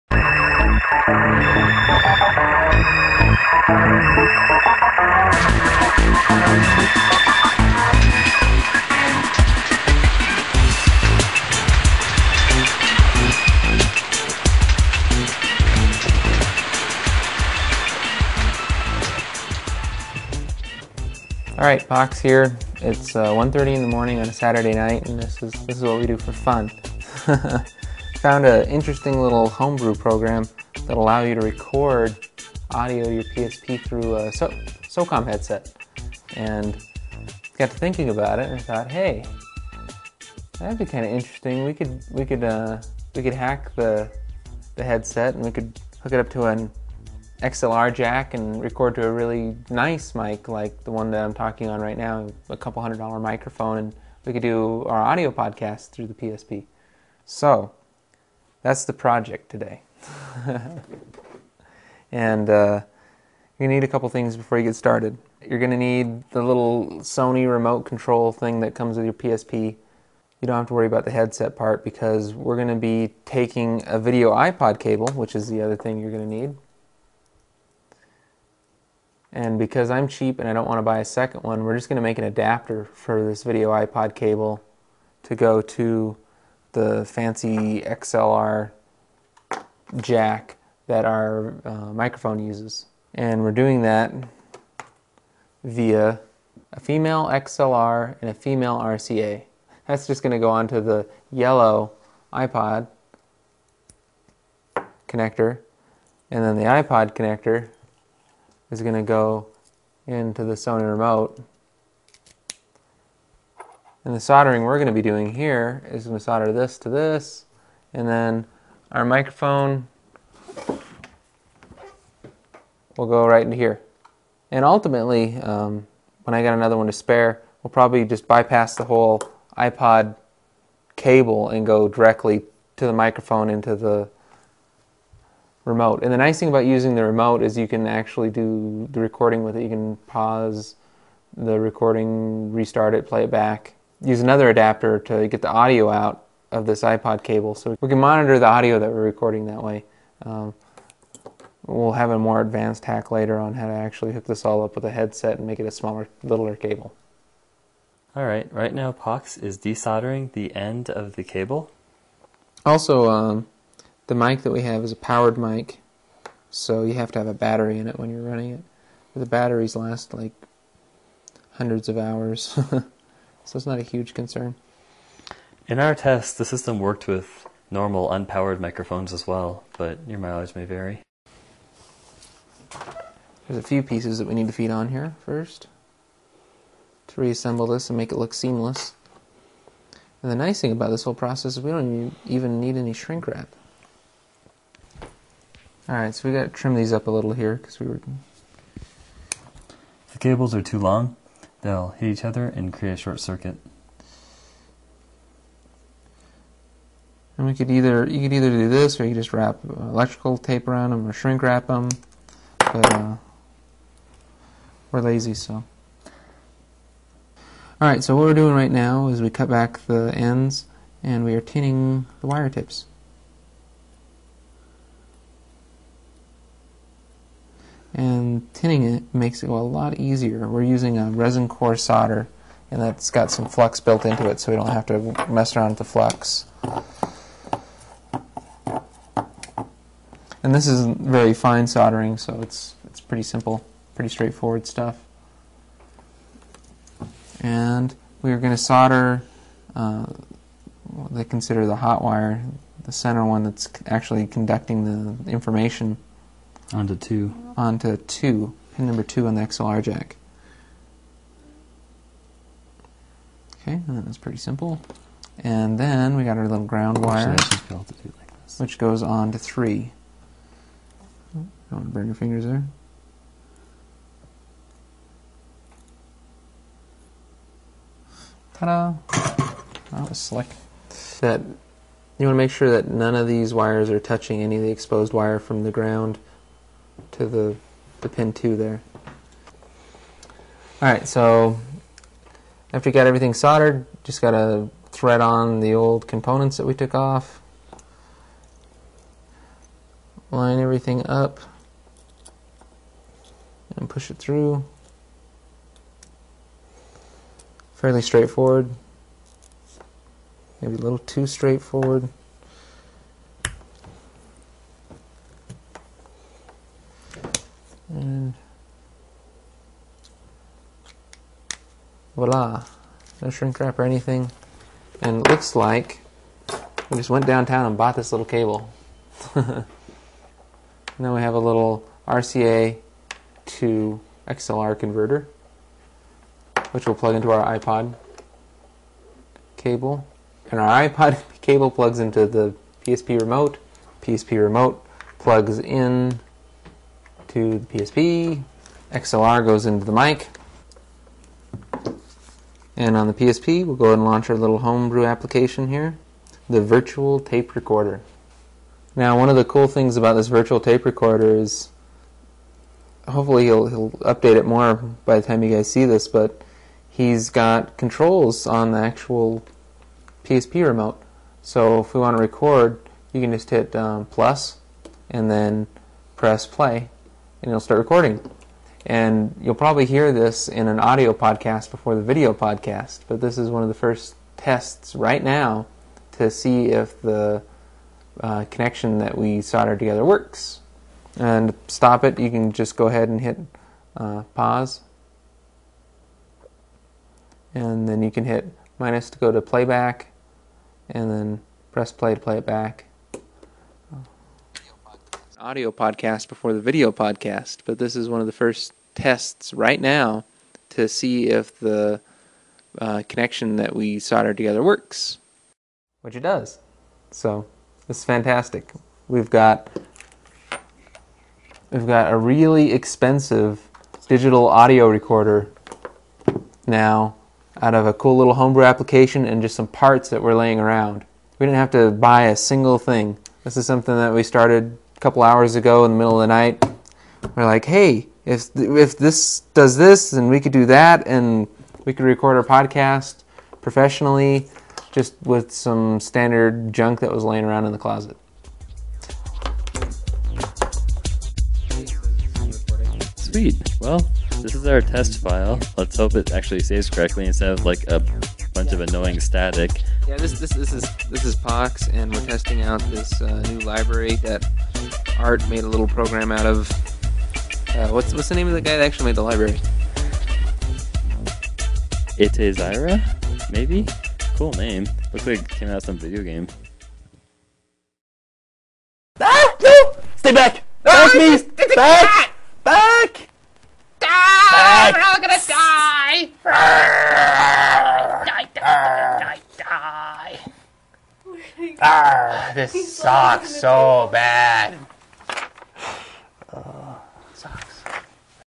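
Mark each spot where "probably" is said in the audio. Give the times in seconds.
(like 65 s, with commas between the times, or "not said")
127 s, 379 s.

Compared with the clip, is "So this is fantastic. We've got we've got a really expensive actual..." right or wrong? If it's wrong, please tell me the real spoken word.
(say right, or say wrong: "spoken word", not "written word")
wrong: "digital", not "actual".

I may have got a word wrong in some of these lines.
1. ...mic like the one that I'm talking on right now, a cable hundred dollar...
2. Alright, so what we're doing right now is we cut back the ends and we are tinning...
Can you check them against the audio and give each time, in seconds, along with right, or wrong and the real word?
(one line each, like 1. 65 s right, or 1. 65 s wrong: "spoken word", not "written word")
1. 50 s wrong: "couple", not "cable"
2. 217 s right.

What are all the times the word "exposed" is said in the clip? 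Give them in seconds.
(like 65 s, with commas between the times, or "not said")
284 s.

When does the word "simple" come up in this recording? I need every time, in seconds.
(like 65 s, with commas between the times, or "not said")
243 s, 264 s.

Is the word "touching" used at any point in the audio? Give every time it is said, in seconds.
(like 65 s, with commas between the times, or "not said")
283 s.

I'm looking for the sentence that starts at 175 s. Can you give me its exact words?
In our test, the system worked with normal unpowered microphones as well, but your mileage may vary.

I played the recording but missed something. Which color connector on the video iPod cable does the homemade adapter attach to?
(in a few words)
yellow.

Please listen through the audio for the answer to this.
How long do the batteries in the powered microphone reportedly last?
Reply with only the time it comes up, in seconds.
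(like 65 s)
171 s.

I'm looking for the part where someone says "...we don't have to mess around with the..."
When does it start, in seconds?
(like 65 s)
234 s.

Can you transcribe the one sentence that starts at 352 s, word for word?
And on the PSP, we'll go ahead and launch our little homebrew application here, the virtual tape recorder.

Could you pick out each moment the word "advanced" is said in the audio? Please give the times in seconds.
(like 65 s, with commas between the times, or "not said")
152 s.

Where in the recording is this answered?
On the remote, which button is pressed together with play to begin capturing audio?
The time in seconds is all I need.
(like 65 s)
374 s.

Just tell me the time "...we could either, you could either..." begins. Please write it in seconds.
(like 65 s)
207 s.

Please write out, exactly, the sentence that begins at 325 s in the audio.
And it looks like we just went downtown and bought this little cable.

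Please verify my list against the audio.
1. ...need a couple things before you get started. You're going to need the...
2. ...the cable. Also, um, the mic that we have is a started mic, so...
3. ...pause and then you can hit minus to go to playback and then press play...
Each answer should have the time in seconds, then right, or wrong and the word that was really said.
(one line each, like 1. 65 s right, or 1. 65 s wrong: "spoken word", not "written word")
1. 63 s right
2. 161 s wrong: "powered", not "started"
3. 394 s right.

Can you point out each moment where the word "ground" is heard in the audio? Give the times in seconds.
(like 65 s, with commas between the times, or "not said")
266 s, 285 s.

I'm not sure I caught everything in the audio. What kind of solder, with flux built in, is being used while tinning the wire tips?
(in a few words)
resin core solder.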